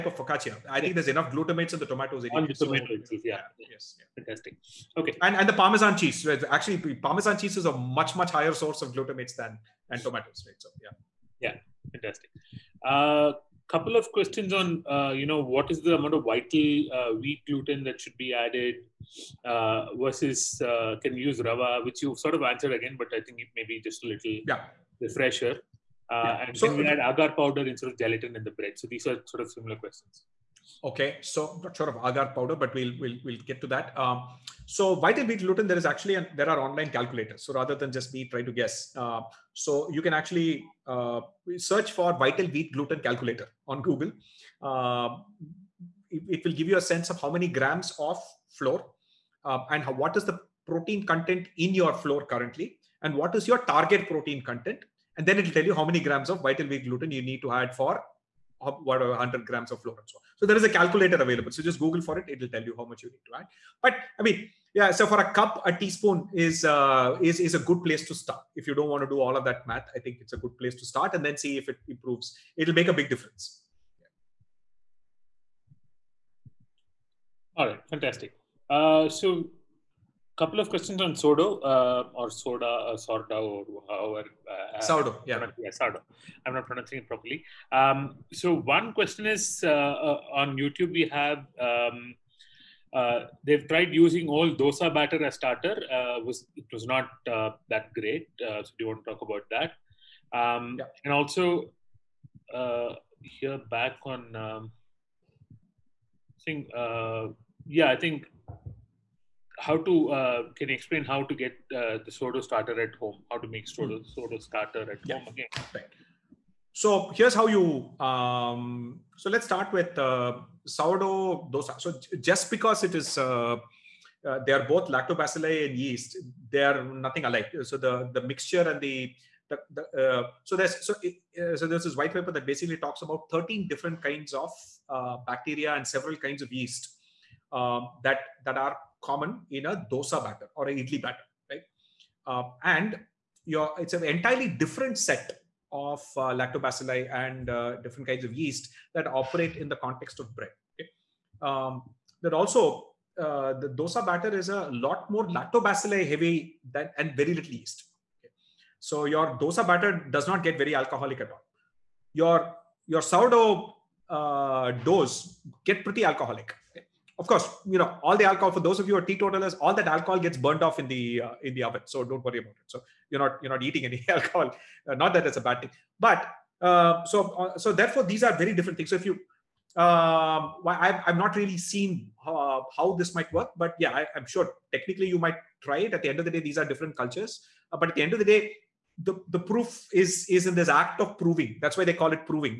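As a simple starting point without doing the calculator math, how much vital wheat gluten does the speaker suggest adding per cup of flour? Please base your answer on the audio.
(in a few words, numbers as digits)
a teaspoon.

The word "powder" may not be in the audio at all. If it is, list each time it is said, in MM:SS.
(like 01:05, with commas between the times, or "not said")
00:27, 00:32.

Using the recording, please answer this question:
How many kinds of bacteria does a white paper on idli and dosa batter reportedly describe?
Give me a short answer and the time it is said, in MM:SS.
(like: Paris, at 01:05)
13, at 02:13.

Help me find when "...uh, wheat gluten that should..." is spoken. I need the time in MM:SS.
00:16.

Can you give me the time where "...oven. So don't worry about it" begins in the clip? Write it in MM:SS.
02:51.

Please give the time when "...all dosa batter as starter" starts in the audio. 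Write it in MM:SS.
01:34.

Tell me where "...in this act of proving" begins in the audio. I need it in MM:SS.
03:10.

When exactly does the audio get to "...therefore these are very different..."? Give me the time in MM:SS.
02:57.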